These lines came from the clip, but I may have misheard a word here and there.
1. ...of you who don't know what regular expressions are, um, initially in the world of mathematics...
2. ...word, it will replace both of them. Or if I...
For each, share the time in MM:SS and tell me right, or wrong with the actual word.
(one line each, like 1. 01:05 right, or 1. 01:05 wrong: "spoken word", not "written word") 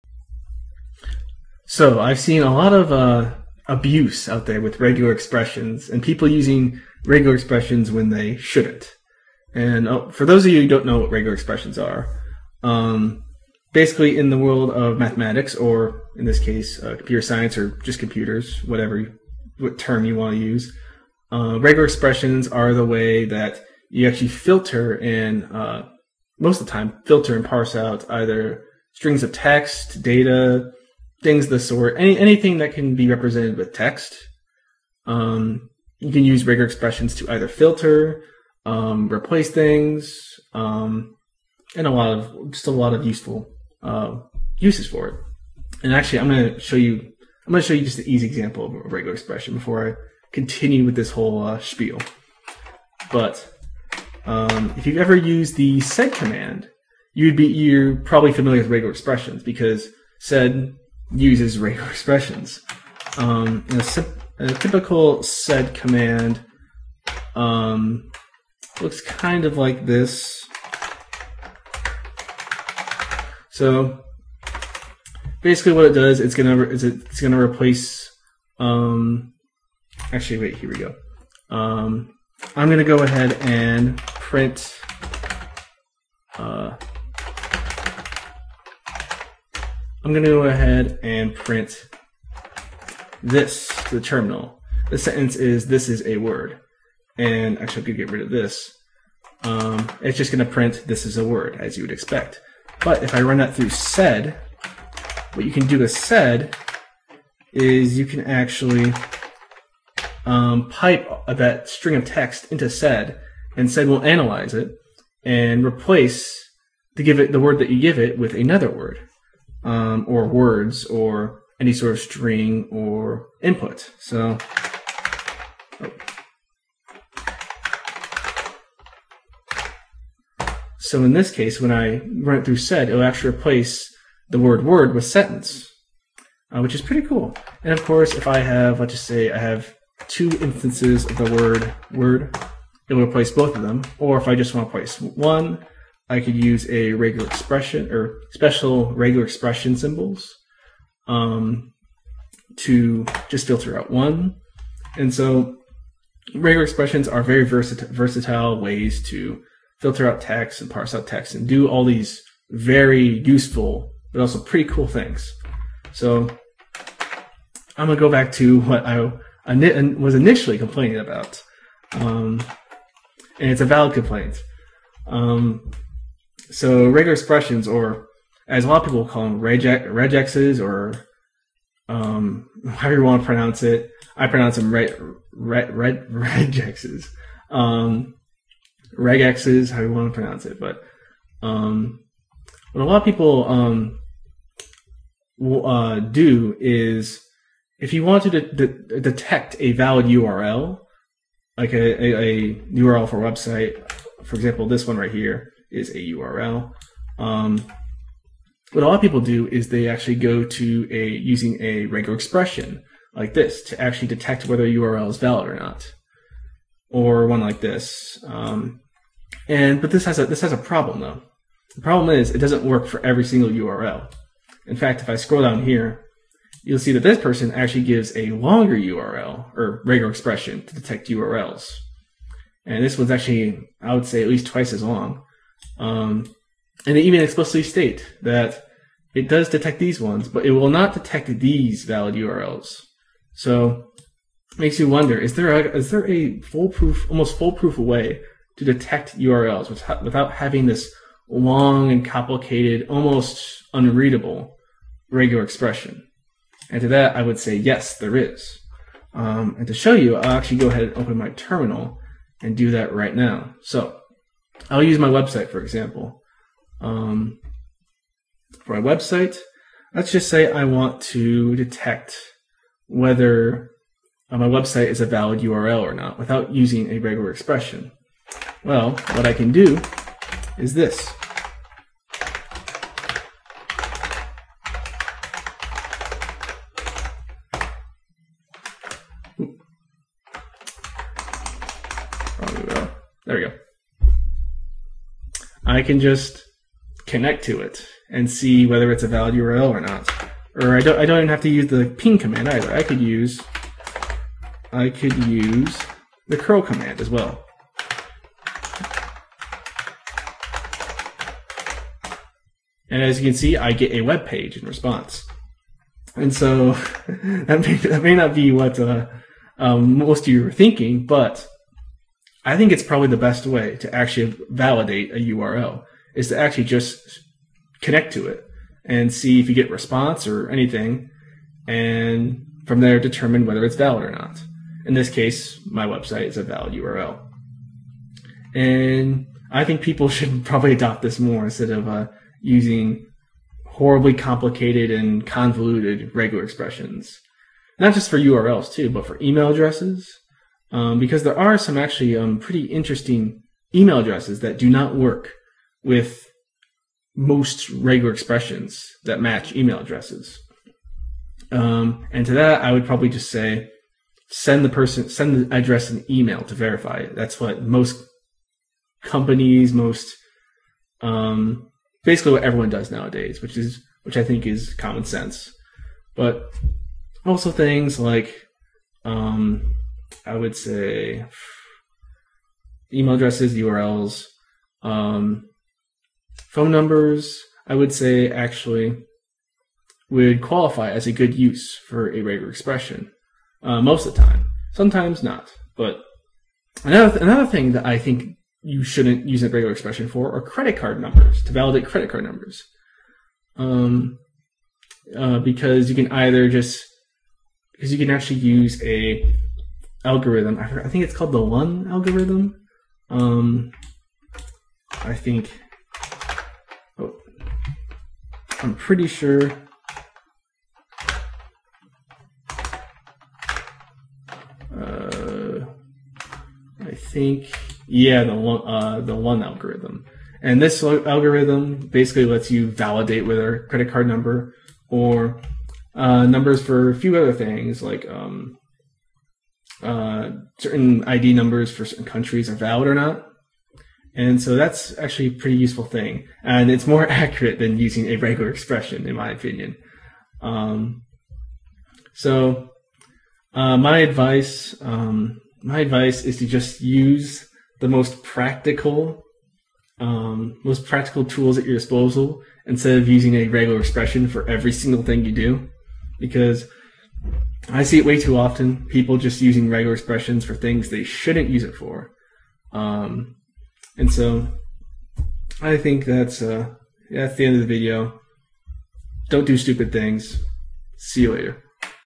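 1. 00:10 wrong: "basically", not "initially"
2. 02:21 right.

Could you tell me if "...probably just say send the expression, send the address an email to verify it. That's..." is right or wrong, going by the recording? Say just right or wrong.
wrong.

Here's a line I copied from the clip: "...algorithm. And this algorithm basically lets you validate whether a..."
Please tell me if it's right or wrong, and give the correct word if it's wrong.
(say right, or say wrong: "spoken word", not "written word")
right.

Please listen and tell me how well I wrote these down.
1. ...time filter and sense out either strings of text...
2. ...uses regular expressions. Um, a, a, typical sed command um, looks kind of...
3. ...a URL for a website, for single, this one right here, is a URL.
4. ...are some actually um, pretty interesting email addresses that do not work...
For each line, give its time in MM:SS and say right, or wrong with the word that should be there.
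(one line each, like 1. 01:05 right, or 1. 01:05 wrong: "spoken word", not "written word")
1. 00:26 wrong: "parse", not "sense"
2. 01:01 right
3. 03:22 wrong: "example", not "single"
4. 05:51 right.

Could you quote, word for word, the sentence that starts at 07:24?
And so that's actually a pretty useful thing.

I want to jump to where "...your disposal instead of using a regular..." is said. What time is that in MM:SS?
07:41.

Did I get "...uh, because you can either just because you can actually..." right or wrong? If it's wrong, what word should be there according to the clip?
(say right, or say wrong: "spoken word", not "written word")
right.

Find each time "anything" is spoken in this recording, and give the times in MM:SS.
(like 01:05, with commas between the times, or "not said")
00:32, 05:30.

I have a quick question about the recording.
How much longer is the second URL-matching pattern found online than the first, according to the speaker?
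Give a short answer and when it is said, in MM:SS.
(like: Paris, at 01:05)
at least twice as long, at 03:54.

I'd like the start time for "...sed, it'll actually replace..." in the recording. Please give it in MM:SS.
02:12.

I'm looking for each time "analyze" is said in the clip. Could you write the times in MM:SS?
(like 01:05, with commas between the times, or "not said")
01:54.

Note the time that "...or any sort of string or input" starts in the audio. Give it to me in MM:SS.
02:00.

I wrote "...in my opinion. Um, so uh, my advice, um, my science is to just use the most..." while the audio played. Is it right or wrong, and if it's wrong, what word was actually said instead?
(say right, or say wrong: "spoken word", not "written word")
wrong: "advice", not "science".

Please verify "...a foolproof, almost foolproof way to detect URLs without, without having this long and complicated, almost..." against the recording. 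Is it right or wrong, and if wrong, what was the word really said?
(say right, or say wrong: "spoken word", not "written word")
right.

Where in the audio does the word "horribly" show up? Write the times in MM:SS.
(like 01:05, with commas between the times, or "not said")
05:43.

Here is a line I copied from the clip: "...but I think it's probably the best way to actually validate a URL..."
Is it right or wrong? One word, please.
right.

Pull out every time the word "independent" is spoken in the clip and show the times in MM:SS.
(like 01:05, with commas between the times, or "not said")
not said.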